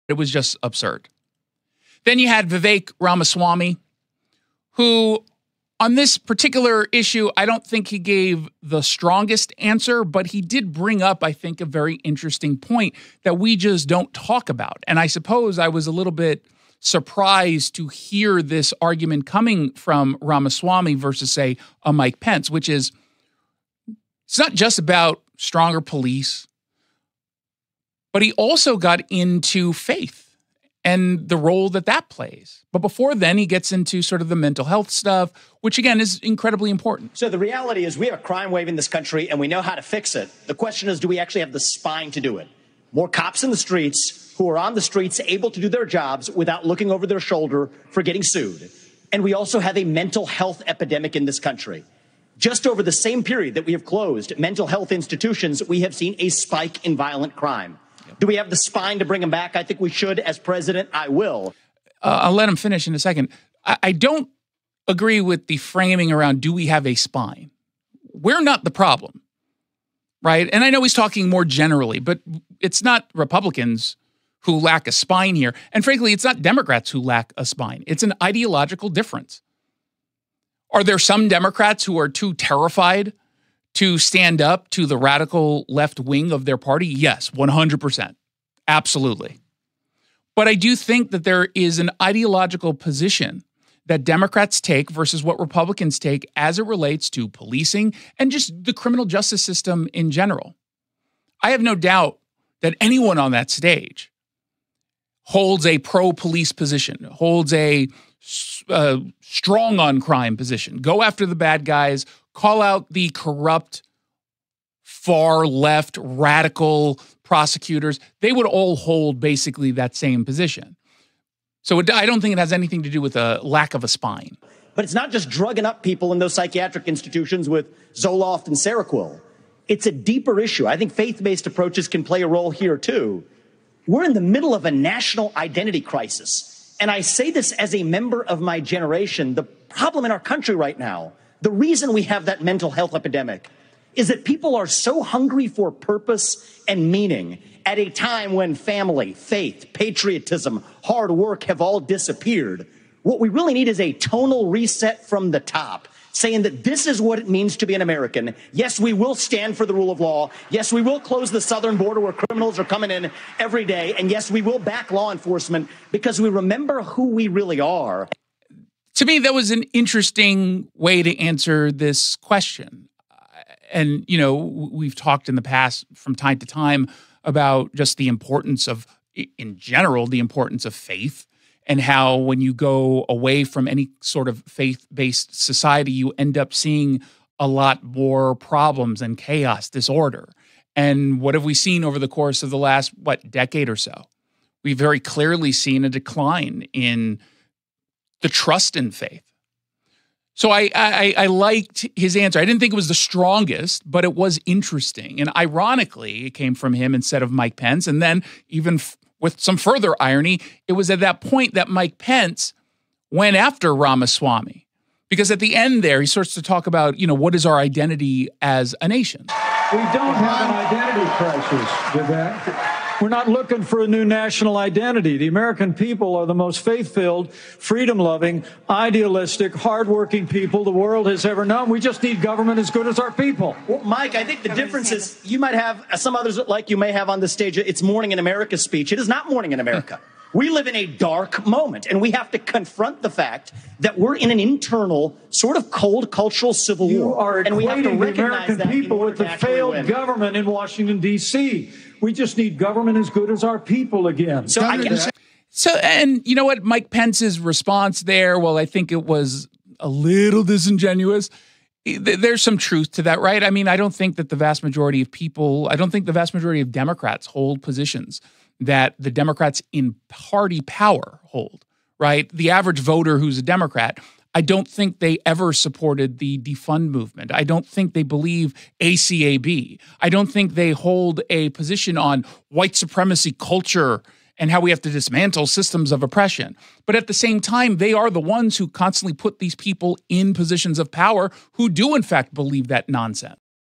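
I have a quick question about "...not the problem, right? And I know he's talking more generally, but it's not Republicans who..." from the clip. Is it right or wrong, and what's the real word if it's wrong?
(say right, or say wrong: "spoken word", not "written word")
right.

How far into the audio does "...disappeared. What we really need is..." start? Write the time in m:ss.
2:31.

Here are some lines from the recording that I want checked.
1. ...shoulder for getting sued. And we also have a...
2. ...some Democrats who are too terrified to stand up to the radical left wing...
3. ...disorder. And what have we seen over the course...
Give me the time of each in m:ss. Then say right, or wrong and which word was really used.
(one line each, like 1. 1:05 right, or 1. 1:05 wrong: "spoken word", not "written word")
1. 0:47 right
2. 1:20 right
3. 3:09 right.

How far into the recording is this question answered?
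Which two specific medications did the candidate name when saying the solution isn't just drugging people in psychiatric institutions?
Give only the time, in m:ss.
2:07.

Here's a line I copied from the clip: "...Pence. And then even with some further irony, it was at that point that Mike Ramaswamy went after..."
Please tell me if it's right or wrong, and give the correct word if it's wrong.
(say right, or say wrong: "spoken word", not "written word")
wrong: "Pence", not "Ramaswamy".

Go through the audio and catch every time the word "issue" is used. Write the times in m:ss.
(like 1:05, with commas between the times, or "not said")
0:06, 2:10.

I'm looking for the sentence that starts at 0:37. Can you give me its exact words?
So the reality is we have a crime wave in this country and we know how to fix it.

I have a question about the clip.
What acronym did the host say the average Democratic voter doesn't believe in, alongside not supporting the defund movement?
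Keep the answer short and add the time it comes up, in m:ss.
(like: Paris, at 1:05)
ACAB, at 4:38.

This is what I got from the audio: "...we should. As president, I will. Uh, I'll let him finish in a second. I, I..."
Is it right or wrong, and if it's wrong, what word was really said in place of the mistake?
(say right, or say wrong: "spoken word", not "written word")
right.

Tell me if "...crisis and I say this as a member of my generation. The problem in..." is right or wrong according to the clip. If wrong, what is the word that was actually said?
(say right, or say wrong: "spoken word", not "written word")
right.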